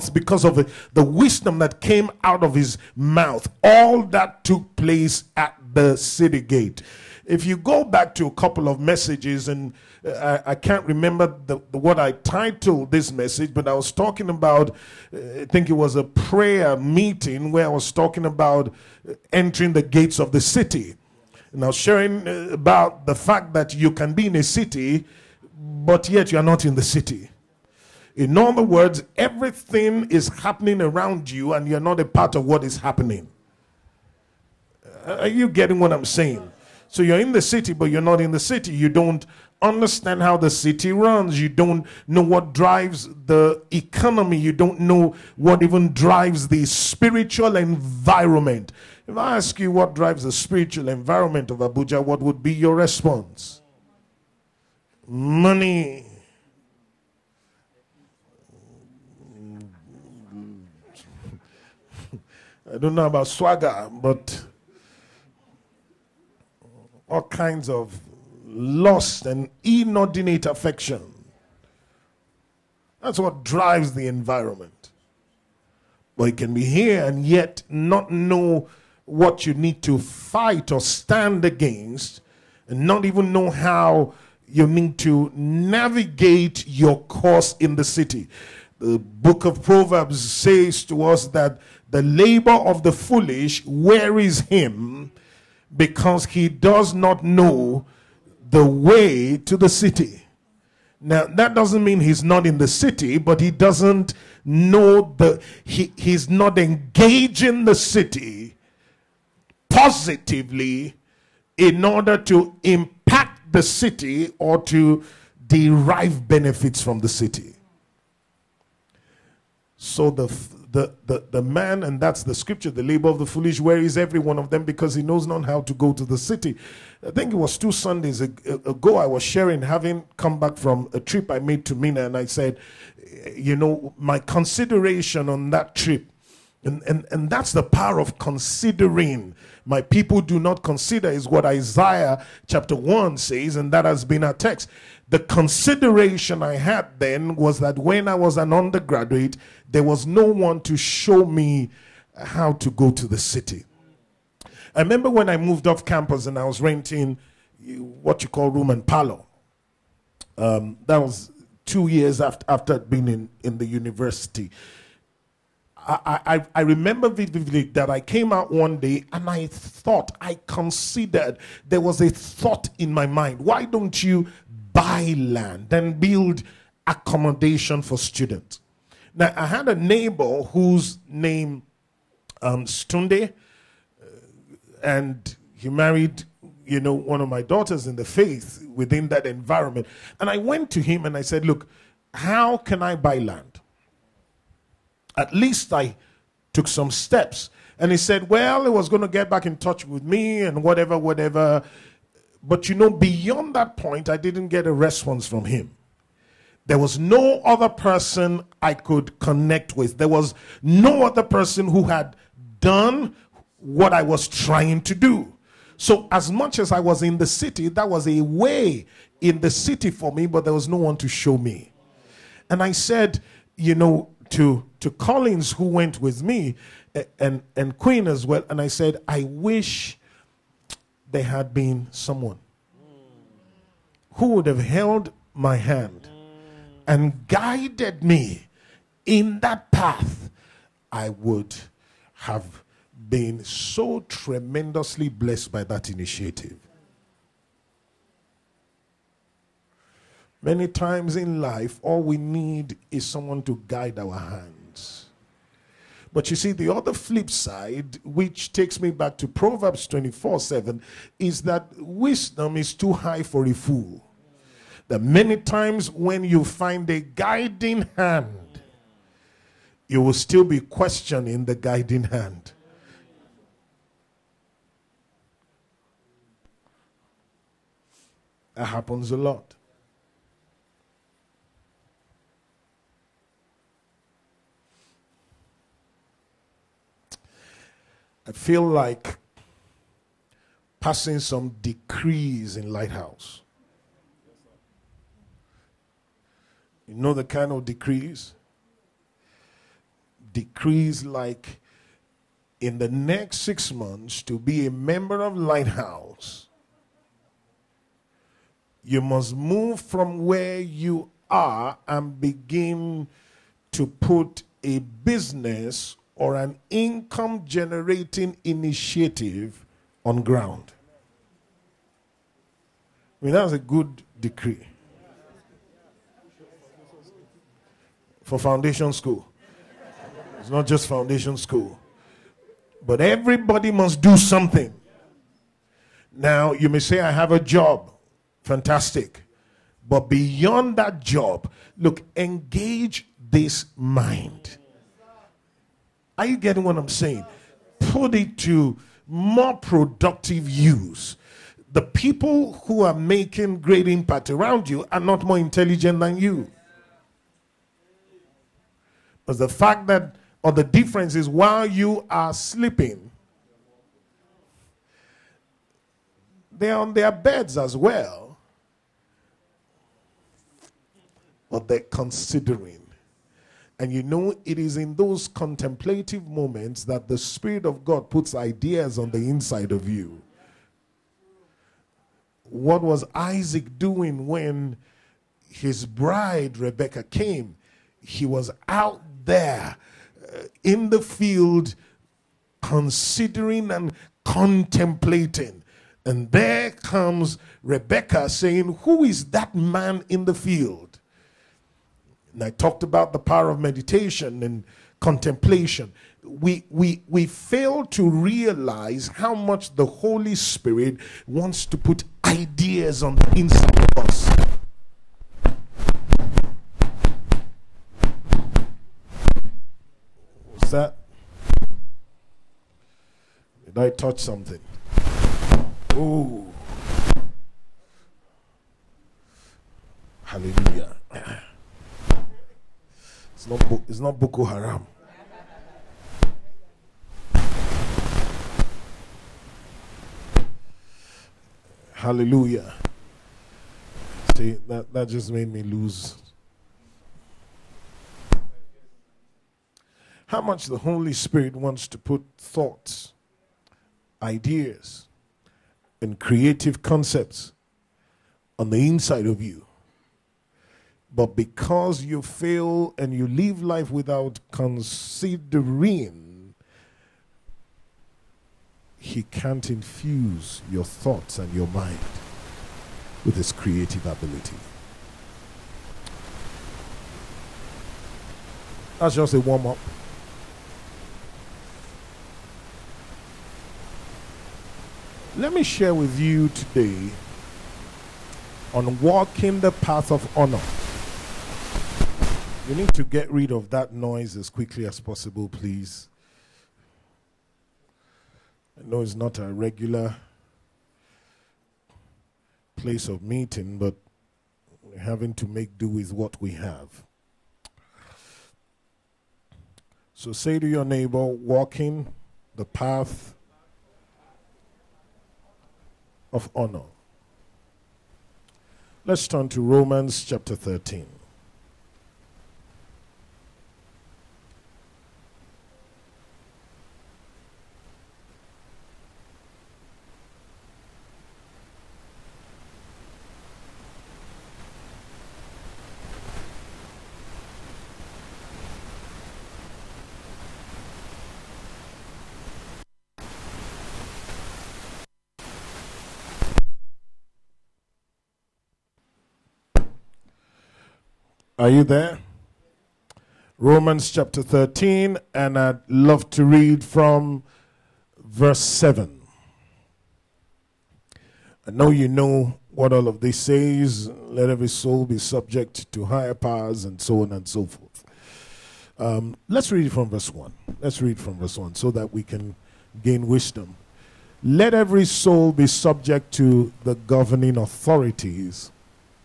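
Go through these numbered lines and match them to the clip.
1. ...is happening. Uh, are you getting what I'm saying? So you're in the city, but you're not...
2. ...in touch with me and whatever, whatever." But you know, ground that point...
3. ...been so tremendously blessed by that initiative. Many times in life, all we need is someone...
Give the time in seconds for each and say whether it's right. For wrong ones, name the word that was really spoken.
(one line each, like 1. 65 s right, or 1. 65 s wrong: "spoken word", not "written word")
1. 32 s right
2. 199 s wrong: "beyond", not "ground"
3. 243 s right.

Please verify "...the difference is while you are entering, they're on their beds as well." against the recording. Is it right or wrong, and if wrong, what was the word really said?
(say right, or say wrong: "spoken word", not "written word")
wrong: "sleeping", not "entering".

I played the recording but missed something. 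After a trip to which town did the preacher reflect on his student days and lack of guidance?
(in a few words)
Minna.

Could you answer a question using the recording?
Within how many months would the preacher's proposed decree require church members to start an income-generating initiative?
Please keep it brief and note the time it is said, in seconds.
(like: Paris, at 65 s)
6, at 303 s.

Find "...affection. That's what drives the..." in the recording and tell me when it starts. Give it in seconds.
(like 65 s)
70 s.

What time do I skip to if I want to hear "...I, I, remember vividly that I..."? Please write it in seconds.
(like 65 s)
166 s.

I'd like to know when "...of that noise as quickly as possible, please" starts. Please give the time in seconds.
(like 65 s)
493 s.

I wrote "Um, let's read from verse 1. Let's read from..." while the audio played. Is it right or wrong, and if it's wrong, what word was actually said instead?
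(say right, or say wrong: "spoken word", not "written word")
right.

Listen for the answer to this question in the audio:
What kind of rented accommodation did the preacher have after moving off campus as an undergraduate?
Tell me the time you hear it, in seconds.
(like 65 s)
158 s.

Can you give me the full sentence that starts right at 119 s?
So the the, the, the man, and that's the scripture, the labor of the foolish, where is every one of them?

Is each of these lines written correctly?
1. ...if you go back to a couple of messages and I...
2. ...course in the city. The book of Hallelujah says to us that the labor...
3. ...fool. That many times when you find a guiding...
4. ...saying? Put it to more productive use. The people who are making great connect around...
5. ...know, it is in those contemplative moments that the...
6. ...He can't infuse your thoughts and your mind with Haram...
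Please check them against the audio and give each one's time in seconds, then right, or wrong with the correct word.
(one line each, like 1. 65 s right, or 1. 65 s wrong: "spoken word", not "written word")
1. 7 s right
2. 87 s wrong: "Proverbs", not "Hallelujah"
3. 263 s right
4. 346 s wrong: "impact", not "connect"
5. 374 s right
6. 468 s wrong: "His", not "Haram".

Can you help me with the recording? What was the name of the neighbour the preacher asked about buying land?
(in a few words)
Stunde.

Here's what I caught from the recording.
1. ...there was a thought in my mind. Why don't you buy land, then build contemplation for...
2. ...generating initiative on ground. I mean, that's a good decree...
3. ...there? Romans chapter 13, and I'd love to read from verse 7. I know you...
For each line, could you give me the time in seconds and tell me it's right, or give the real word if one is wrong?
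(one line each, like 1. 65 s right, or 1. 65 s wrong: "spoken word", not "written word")
1. 171 s wrong: "accommodation", not "contemplation"
2. 317 s right
3. 551 s right.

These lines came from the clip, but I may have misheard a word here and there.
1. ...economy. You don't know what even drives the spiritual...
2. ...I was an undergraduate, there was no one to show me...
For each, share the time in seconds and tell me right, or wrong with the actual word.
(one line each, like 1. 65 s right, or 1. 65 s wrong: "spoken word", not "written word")
1. 43 s right
2. 148 s right.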